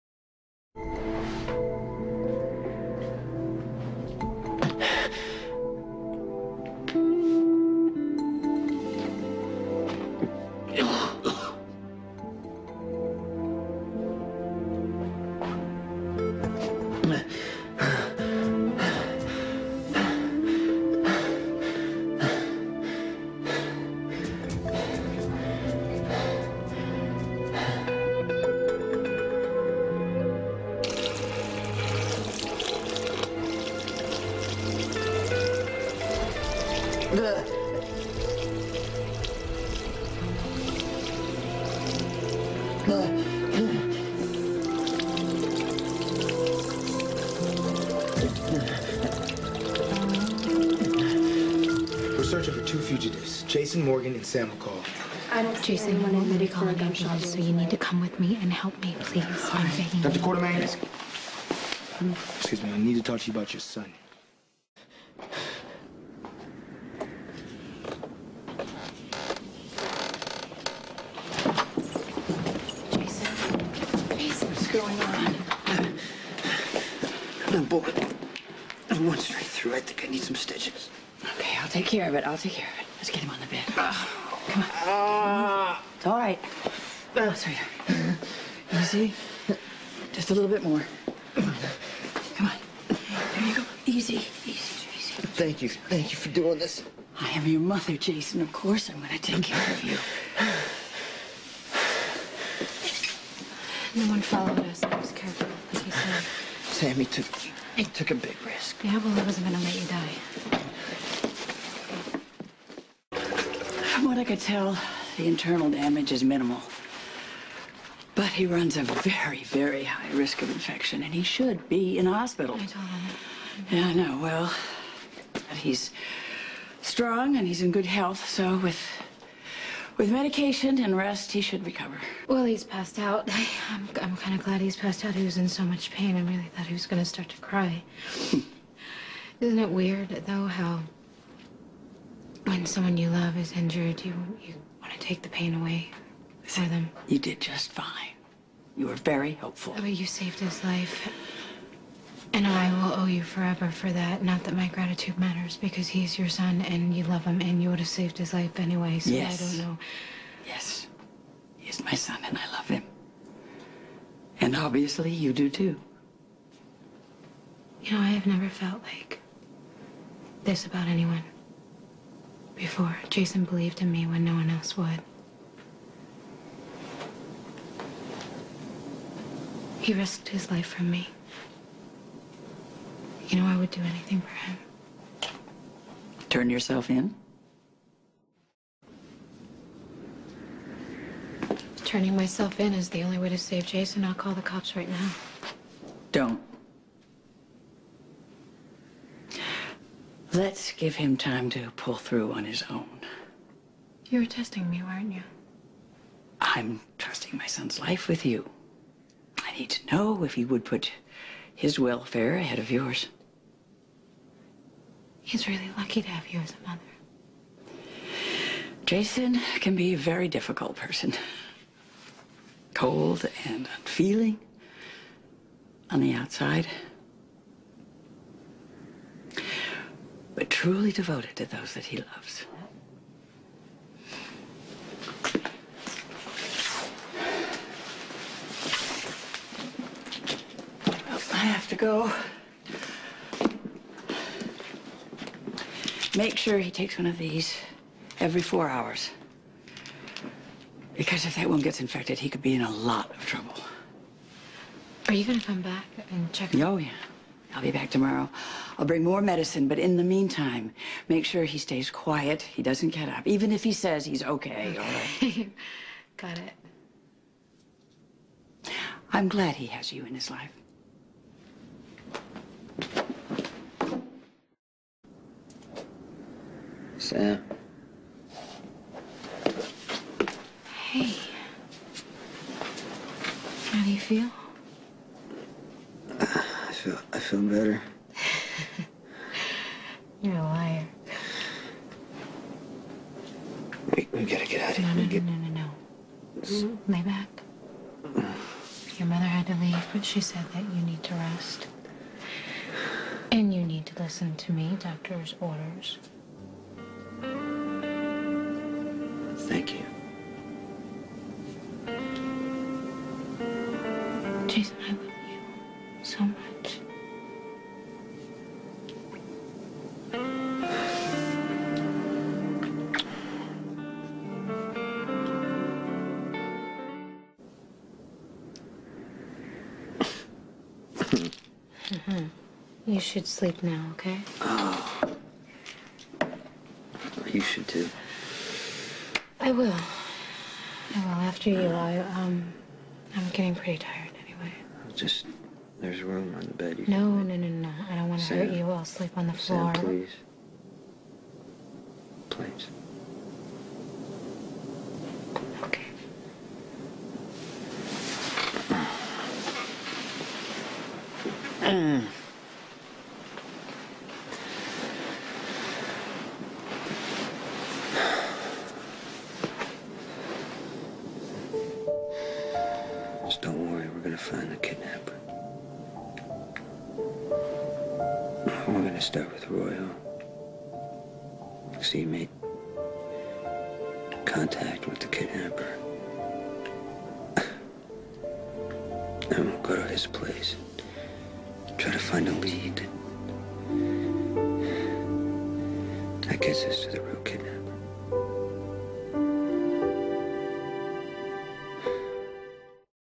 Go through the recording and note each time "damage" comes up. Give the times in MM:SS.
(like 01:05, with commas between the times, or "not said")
01:55.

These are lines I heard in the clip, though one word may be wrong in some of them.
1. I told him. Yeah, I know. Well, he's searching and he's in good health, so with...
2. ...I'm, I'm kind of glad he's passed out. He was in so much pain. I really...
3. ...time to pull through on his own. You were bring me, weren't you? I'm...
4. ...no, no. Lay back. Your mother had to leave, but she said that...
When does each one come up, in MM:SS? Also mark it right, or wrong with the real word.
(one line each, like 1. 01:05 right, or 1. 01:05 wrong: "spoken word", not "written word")
1. 02:02 wrong: "strong", not "searching"
2. 02:13 right
3. 03:21 wrong: "testing", not "bring"
4. 04:55 right.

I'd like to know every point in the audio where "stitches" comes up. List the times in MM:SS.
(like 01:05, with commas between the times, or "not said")
01:20.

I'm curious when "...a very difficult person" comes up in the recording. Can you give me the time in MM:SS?
03:39.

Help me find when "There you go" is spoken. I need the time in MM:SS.
01:33.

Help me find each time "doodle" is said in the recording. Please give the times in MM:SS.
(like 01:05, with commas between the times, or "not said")
not said.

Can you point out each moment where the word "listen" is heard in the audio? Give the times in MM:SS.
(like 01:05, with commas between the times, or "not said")
05:04.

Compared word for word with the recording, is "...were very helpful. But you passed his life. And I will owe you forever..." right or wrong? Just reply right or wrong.
wrong.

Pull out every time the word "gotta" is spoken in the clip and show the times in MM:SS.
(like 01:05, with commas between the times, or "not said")
04:54.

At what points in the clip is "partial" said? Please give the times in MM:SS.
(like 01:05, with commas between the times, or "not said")
not said.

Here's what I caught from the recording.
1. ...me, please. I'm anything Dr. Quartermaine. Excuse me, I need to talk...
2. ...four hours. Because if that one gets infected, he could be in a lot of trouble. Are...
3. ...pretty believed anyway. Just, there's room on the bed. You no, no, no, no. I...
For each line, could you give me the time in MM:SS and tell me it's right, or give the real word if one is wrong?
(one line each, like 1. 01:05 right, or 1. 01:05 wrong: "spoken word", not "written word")
1. 00:58 wrong: "begging", not "anything"
2. 04:08 right
3. 05:43 wrong: "tired", not "believed".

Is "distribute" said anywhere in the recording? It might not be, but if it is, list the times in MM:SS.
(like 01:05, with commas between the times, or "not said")
not said.